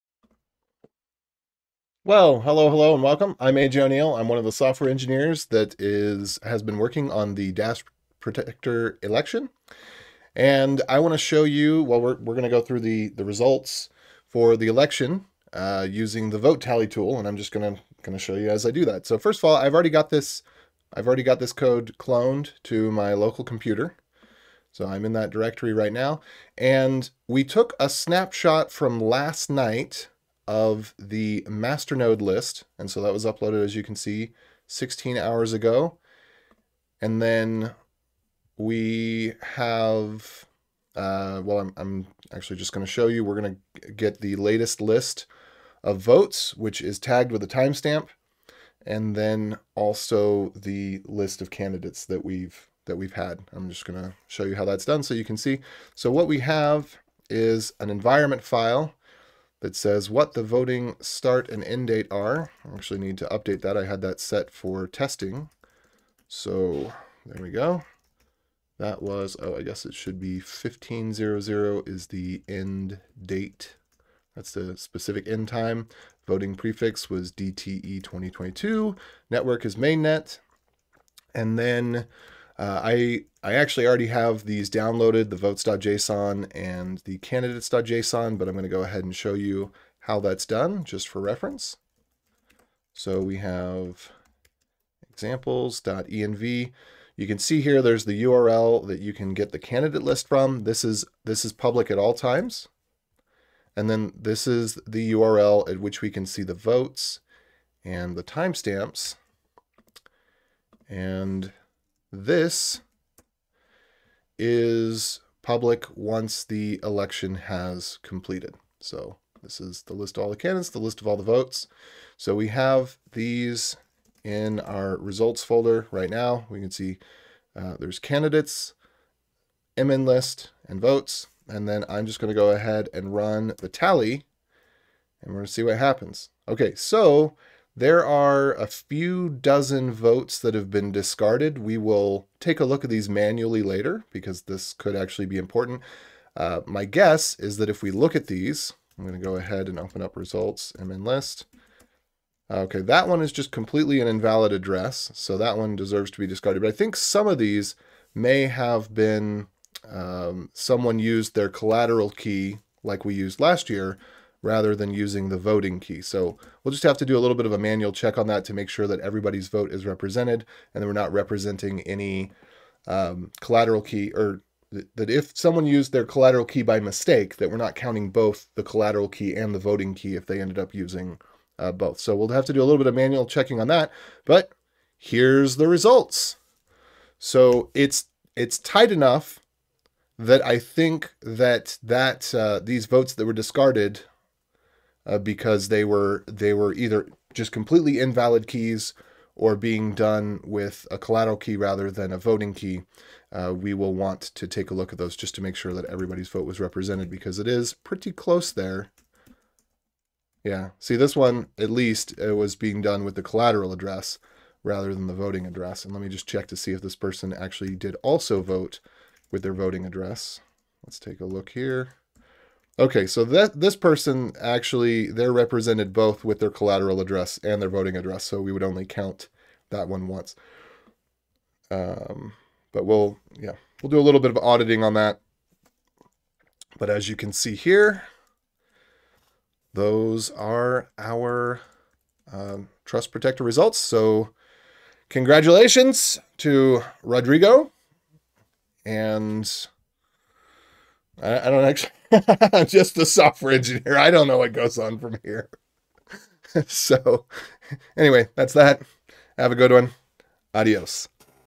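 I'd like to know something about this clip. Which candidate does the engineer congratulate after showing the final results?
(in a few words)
Rodrigo.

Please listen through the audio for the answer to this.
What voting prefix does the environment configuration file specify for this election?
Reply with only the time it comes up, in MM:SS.
01:17.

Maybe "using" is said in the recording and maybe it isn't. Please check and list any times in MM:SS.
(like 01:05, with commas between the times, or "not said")
00:15, 02:44, 03:00.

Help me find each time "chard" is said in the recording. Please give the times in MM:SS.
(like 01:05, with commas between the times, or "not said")
not said.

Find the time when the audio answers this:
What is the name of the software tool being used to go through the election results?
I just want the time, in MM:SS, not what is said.
00:16.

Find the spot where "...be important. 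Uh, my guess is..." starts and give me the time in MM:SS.
02:25.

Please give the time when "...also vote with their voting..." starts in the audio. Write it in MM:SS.
03:38.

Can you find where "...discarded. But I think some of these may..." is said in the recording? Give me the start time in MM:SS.
02:36.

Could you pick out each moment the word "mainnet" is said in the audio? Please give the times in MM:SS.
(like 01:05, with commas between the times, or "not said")
01:19.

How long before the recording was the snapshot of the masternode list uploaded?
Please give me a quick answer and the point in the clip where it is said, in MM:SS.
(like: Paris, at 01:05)
16 hours ago, at 00:34.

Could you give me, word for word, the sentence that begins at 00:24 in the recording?
So I'm in that directory right now.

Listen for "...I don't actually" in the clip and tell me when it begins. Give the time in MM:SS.
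04:11.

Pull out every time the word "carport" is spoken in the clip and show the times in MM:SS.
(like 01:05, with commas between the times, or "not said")
not said.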